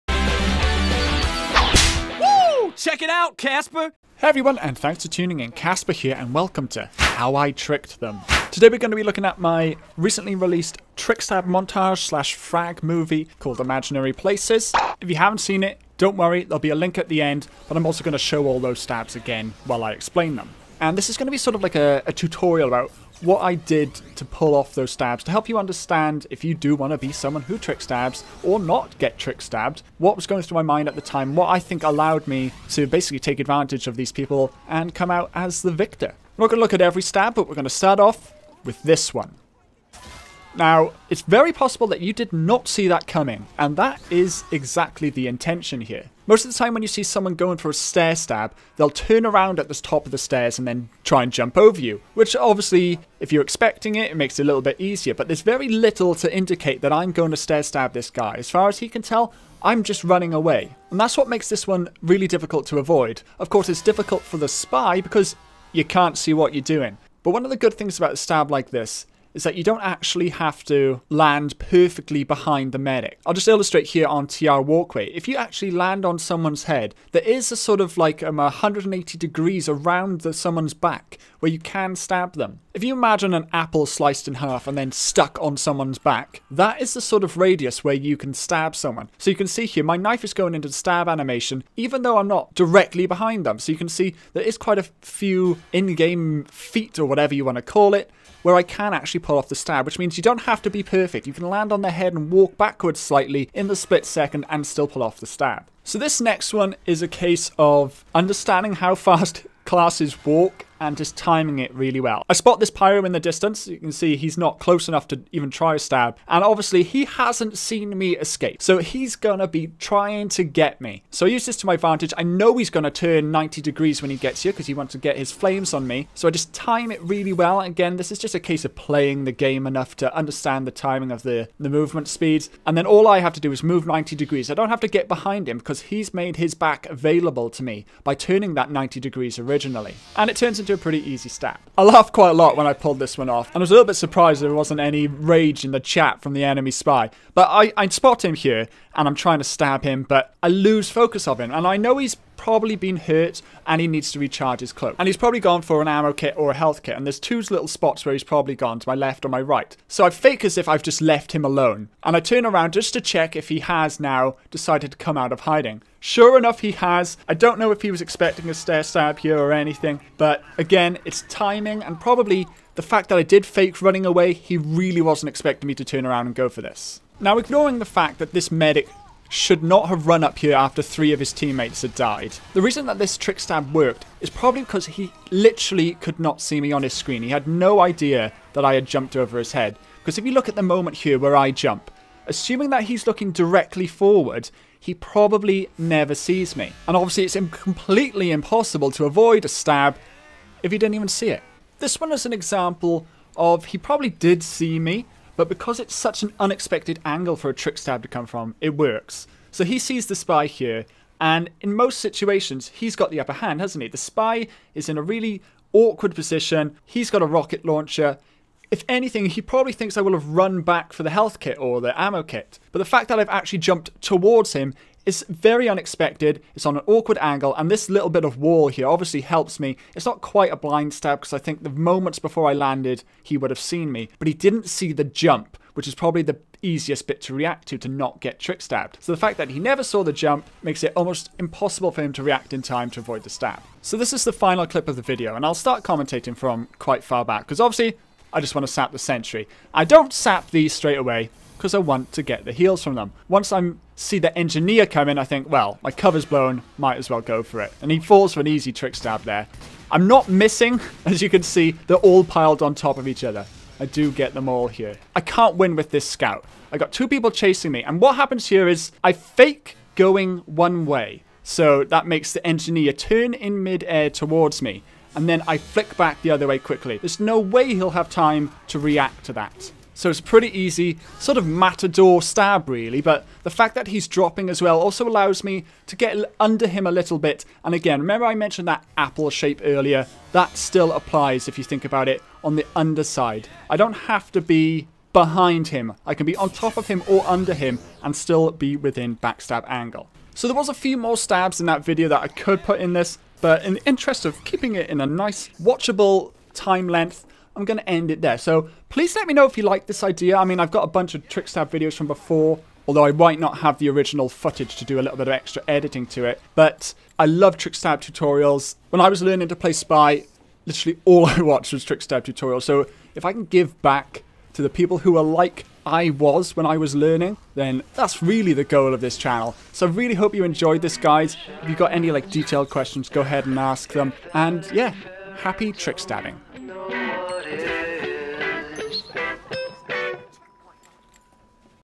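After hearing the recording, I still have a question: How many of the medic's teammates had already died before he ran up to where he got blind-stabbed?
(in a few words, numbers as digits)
3.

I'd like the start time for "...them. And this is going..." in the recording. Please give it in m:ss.
0:20.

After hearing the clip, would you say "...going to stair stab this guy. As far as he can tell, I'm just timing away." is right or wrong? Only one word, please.
wrong.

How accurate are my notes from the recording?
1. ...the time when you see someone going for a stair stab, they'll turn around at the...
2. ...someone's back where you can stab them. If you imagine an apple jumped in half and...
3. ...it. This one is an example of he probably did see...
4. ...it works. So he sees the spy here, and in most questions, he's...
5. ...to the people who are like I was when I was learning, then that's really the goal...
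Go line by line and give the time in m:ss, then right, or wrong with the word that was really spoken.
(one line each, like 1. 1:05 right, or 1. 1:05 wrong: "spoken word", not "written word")
1. 0:46 right
2. 1:20 wrong: "sliced", not "jumped"
3. 3:21 right
4. 3:28 wrong: "situations", not "questions"
5. 5:24 right.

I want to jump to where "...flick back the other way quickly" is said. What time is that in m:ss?
4:35.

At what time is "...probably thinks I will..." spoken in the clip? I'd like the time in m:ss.
3:39.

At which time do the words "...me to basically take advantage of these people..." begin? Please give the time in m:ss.
0:32.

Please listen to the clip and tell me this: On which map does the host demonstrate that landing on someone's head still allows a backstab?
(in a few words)
TR Walkway.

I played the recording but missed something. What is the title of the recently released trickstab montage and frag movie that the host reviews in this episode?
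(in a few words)
Imaginary Places.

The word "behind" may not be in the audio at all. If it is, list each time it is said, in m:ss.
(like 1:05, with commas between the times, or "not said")
1:12, 1:33, 2:15, 4:55.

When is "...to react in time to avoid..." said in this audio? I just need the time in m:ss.
4:02.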